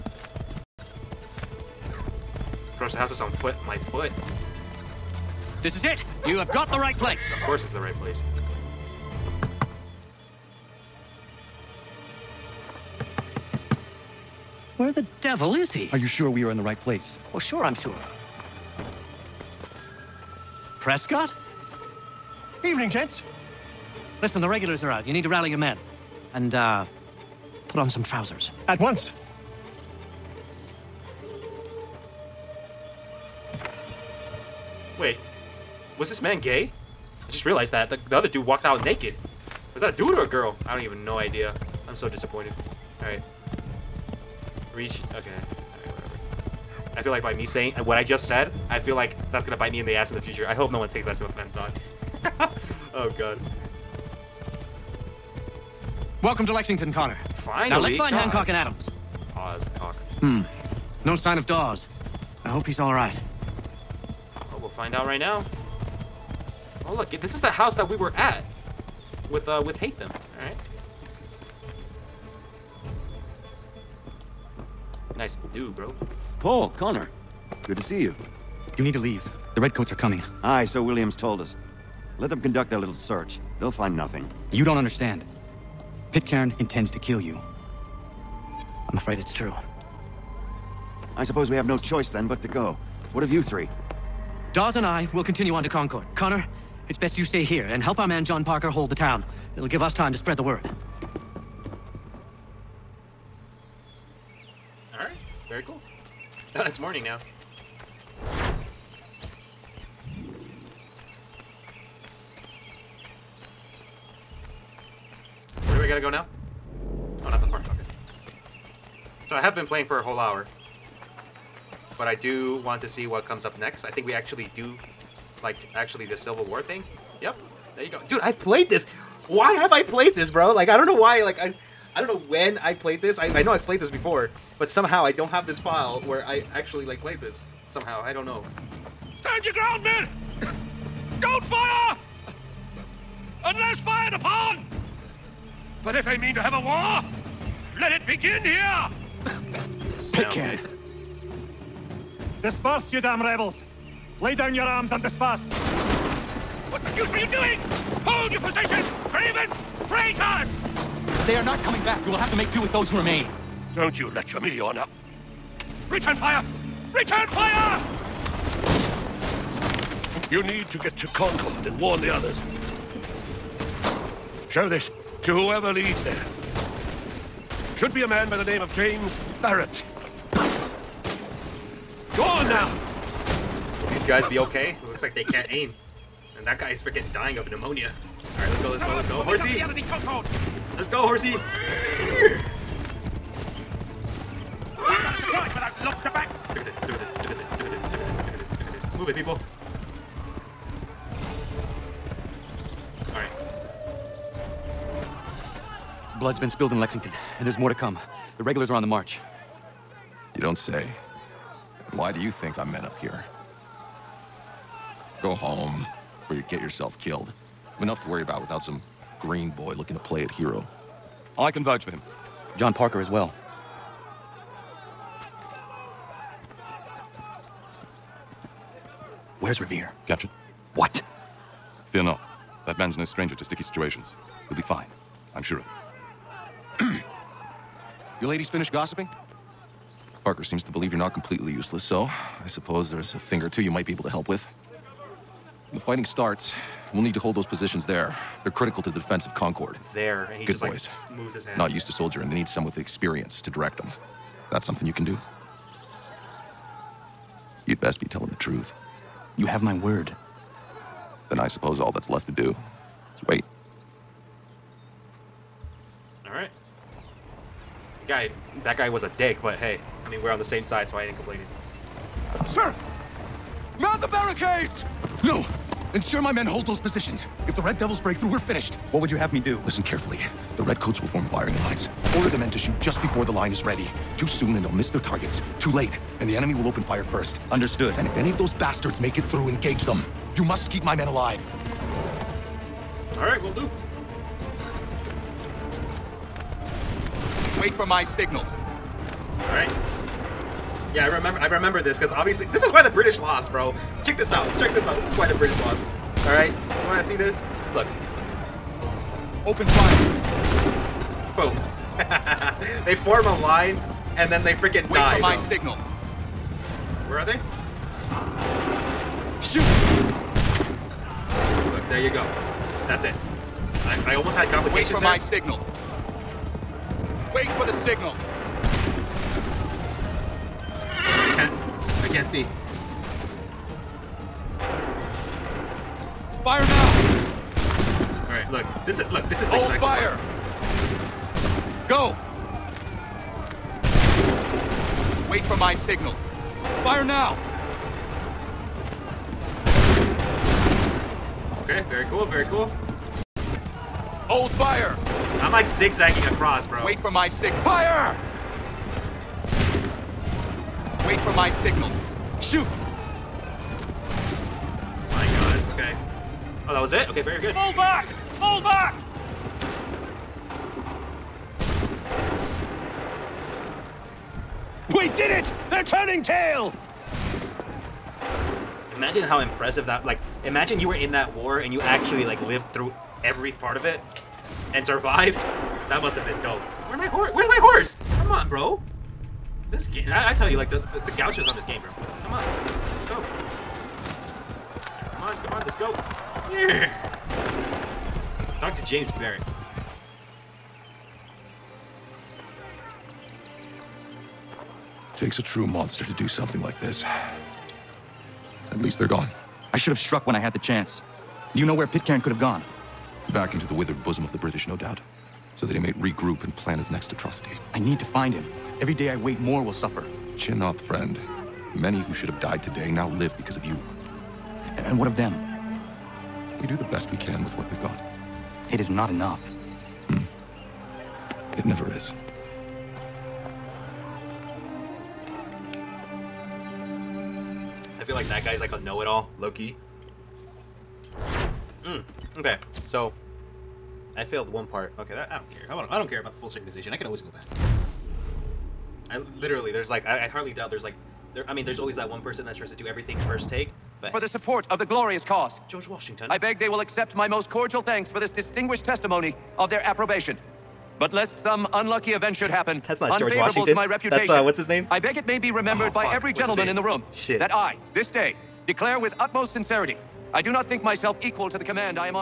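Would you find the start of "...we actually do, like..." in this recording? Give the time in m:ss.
2:04.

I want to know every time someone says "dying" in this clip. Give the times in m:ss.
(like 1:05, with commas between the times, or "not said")
3:07.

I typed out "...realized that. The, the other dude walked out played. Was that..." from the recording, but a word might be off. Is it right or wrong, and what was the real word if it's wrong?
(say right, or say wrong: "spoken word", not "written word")
wrong: "naked", not "played".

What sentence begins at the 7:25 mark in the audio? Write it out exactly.
I don't, I don't care about the full synchronization.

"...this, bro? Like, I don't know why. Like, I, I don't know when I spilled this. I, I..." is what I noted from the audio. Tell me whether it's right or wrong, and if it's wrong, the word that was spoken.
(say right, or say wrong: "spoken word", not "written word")
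wrong: "played", not "spilled".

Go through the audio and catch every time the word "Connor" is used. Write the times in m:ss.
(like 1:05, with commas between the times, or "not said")
0:56, 1:16, 1:36.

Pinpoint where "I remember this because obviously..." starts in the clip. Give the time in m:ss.
5:01.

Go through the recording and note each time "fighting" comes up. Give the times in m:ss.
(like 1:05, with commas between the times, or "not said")
4:05.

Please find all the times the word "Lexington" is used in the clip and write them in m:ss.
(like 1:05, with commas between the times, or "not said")
0:56, 3:26.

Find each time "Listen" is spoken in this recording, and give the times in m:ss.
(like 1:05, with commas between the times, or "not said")
0:24, 4:39.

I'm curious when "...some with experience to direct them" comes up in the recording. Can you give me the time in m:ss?
4:12.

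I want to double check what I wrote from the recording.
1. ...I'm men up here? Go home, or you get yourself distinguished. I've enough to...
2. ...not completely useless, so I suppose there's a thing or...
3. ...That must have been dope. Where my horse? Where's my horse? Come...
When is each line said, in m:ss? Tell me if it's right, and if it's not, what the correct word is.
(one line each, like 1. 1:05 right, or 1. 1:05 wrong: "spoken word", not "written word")
1. 3:32 wrong: "killed", not "distinguished"
2. 4:00 right
3. 6:25 right.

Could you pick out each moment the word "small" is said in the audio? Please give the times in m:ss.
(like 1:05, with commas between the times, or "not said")
not said.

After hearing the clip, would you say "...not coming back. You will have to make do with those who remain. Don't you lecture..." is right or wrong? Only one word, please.
right.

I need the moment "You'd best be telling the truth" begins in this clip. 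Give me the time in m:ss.
4:17.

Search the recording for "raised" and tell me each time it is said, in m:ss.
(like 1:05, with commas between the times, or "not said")
not said.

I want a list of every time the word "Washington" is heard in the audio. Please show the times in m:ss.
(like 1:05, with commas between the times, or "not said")
7:35, 7:43.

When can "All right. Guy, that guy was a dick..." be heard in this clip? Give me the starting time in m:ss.
4:26.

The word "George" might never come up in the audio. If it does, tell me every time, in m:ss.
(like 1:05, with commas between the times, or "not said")
7:35, 7:43.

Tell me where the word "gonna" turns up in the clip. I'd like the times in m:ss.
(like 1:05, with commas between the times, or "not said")
0:49.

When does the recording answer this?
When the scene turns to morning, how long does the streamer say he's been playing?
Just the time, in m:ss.
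1:59.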